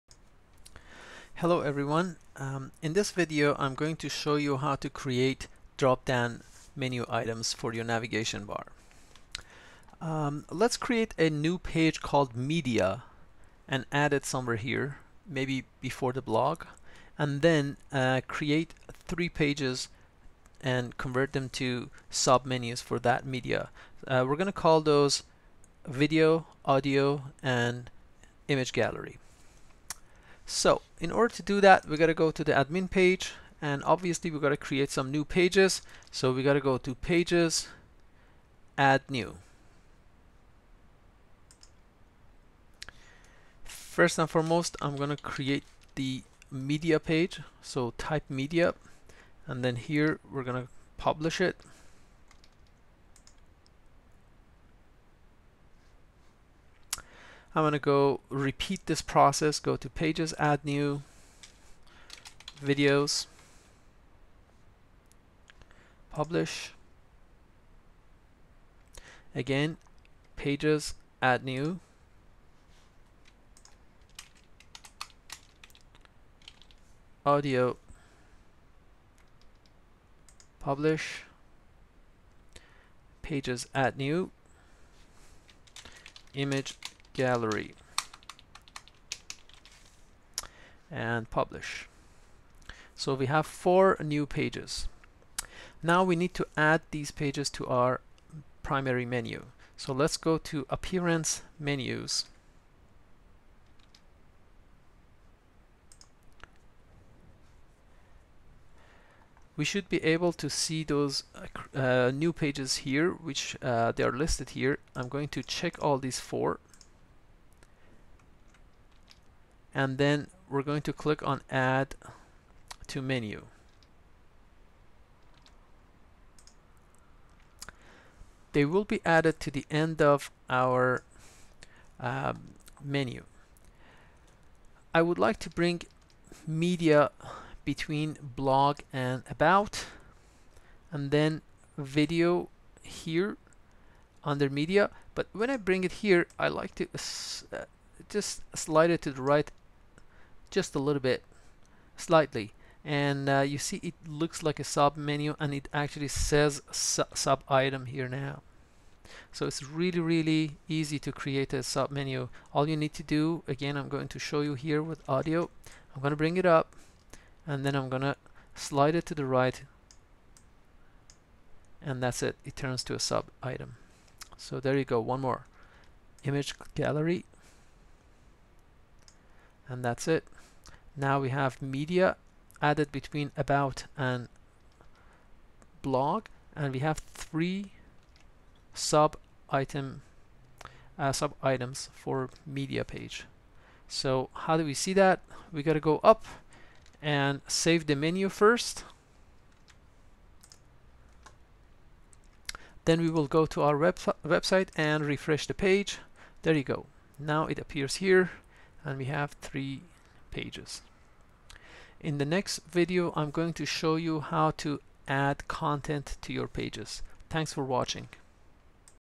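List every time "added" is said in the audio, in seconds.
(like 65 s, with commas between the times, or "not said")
129 s, 182 s.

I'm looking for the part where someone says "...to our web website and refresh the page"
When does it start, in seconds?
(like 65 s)
203 s.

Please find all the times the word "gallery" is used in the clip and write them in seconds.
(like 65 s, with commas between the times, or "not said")
28 s, 87 s, 176 s.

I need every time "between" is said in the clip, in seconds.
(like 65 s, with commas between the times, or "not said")
137 s, 182 s.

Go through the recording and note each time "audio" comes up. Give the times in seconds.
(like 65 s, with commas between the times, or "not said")
26 s, 77 s, 165 s.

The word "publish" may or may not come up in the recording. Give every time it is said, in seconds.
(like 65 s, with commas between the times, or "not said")
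50 s, 66 s, 80 s, 91 s.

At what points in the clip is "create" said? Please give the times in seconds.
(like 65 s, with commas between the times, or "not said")
4 s, 10 s, 18 s, 34 s, 45 s, 161 s.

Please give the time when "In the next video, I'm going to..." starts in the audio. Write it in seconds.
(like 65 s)
211 s.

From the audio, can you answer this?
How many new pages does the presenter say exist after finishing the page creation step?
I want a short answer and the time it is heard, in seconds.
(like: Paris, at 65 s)
4, at 93 s.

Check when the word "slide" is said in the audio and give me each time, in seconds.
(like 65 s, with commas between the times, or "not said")
148 s, 168 s.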